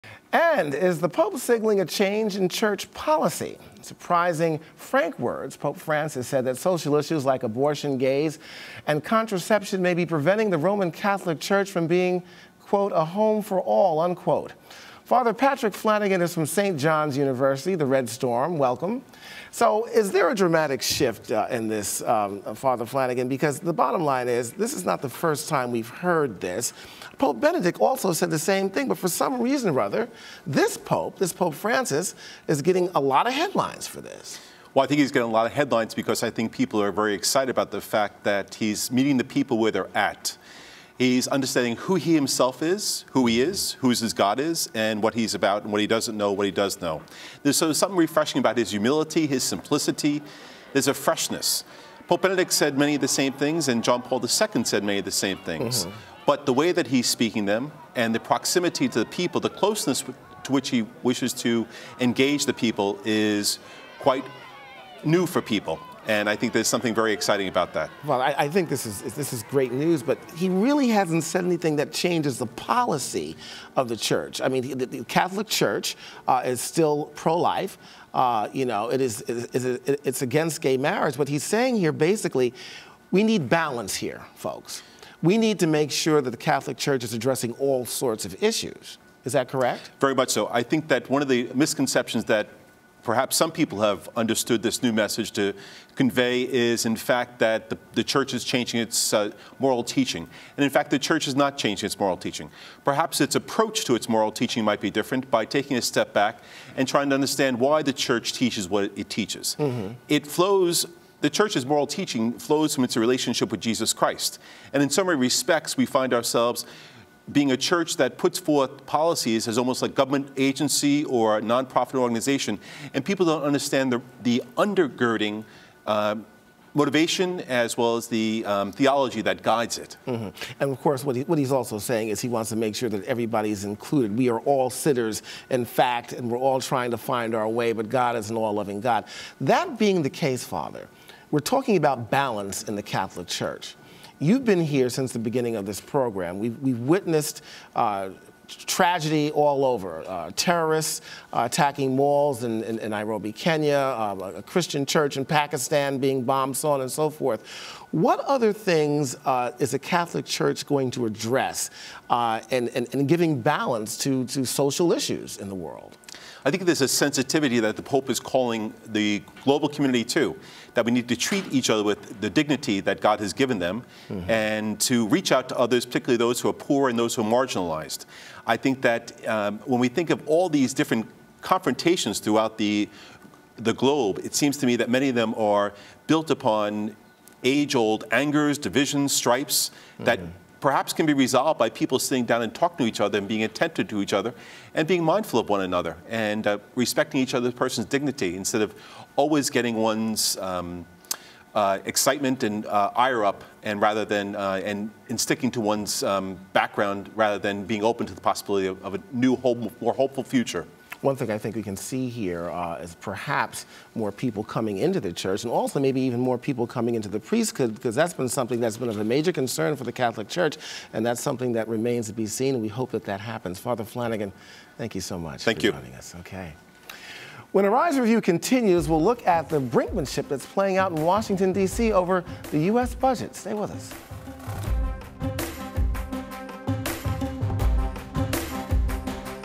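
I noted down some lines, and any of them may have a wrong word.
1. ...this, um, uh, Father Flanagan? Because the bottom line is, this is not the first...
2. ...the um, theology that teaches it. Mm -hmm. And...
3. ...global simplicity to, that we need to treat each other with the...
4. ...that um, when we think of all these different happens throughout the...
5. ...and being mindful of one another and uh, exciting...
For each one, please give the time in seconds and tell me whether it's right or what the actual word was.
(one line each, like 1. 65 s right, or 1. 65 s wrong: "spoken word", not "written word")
1. 21 s right
2. 128 s wrong: "guides", not "teaches"
3. 169 s wrong: "community", not "simplicity"
4. 178 s wrong: "confrontations", not "happens"
5. 194 s wrong: "respecting", not "exciting".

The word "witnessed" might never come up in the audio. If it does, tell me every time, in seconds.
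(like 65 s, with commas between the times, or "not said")
146 s.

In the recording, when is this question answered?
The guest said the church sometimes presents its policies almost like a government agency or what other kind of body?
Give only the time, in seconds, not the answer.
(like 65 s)
121 s.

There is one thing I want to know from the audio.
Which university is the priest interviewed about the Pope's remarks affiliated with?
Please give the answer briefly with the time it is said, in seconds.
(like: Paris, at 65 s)
St. John's University, at 16 s.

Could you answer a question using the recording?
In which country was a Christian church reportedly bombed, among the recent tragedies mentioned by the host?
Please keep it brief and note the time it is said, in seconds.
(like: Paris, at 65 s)
Pakistan, at 155 s.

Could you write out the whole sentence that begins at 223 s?
Father Flanagan, thank you so much thank for you.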